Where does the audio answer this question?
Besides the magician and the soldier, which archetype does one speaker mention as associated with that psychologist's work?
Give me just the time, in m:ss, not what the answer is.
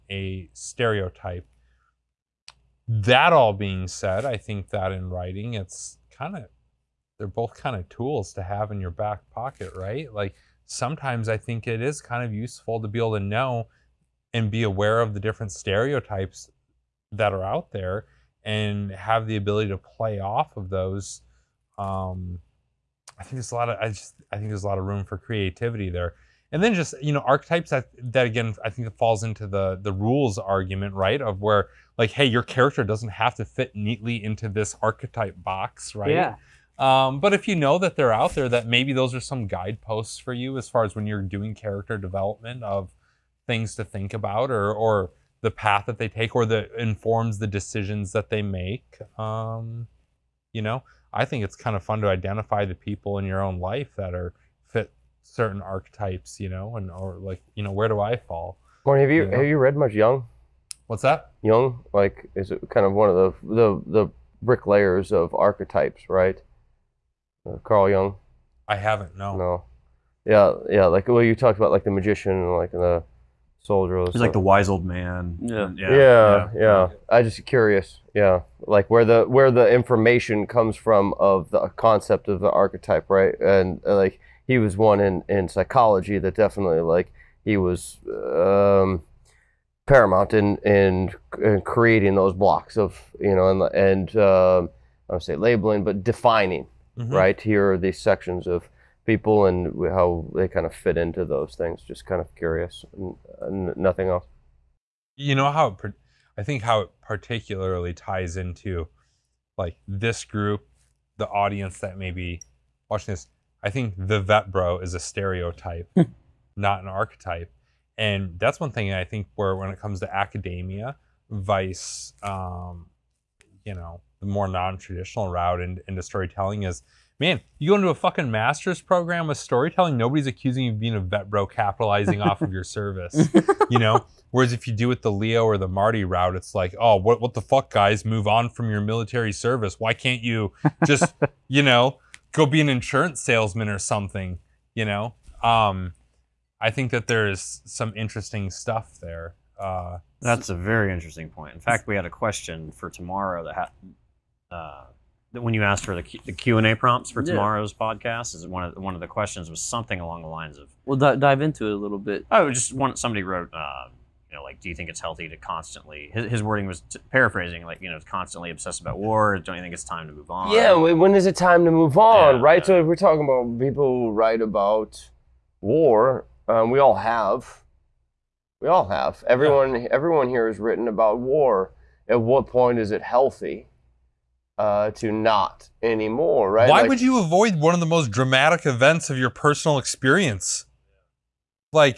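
1:14.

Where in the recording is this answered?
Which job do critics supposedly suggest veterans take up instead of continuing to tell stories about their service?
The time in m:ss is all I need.
2:22.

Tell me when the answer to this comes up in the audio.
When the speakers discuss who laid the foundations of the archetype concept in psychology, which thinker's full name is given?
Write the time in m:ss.
1:07.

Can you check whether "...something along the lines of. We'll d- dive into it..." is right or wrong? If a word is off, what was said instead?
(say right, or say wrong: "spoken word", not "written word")
right.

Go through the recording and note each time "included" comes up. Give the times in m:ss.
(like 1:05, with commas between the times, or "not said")
not said.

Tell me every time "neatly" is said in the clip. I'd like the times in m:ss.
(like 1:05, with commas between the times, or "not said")
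0:33.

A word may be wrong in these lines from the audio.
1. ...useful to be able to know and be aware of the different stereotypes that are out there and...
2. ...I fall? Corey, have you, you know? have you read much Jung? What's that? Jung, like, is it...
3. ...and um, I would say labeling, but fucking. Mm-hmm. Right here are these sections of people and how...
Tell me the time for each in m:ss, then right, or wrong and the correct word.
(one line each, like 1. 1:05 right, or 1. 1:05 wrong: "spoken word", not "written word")
1. 0:12 right
2. 0:57 right
3. 1:33 wrong: "defining", not "fucking".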